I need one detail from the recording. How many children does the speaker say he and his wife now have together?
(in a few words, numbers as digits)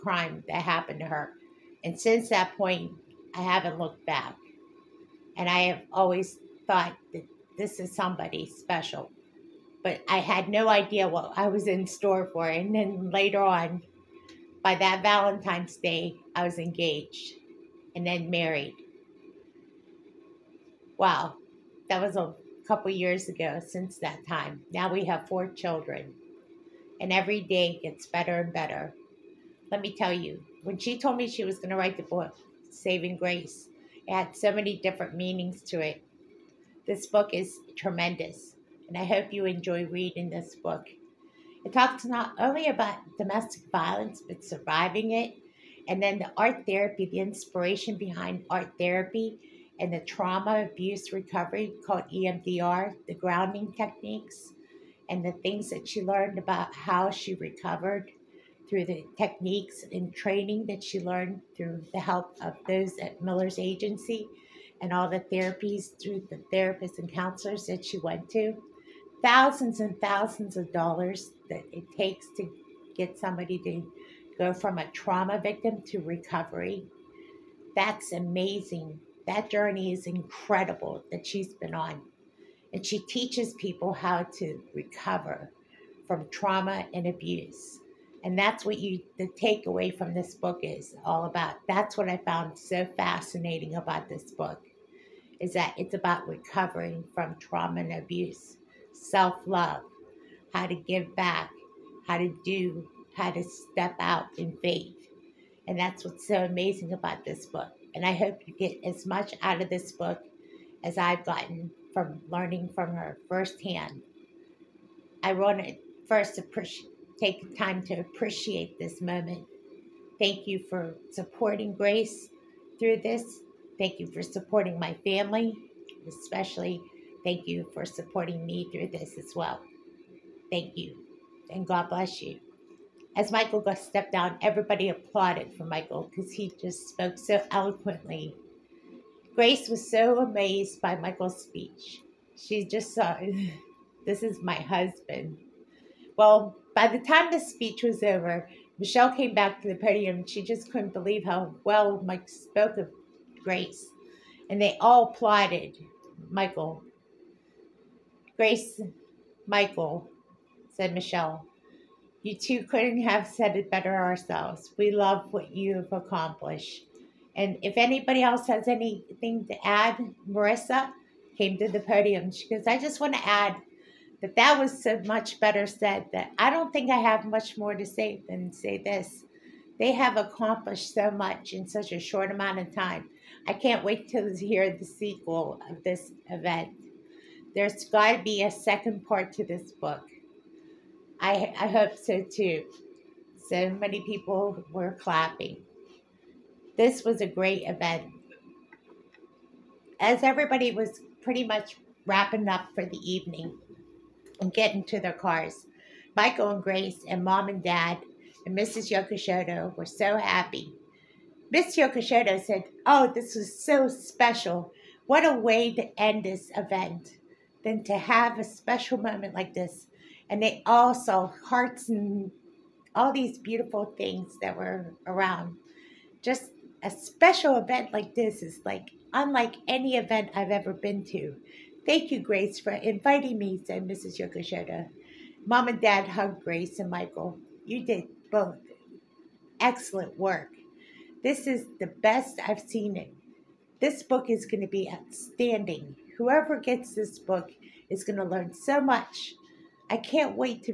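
4.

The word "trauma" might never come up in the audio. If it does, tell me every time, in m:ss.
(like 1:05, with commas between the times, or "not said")
0:50, 1:14, 1:26, 1:37.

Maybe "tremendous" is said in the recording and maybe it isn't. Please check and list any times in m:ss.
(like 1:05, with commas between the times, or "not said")
0:37.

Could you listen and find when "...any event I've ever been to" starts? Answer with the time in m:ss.
3:49.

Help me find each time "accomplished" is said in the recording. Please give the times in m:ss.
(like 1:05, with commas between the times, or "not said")
2:45, 3:00.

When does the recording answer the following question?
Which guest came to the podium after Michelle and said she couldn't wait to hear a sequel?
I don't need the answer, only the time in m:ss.
2:50.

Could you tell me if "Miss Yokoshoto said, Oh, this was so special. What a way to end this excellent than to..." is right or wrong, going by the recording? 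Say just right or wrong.
wrong.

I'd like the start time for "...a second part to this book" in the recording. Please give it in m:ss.
3:08.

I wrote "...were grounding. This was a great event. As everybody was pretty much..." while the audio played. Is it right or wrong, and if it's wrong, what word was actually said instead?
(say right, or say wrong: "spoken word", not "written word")
wrong: "clapping", not "grounding".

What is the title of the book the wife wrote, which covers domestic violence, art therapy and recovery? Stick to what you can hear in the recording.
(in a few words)
Saving Grace.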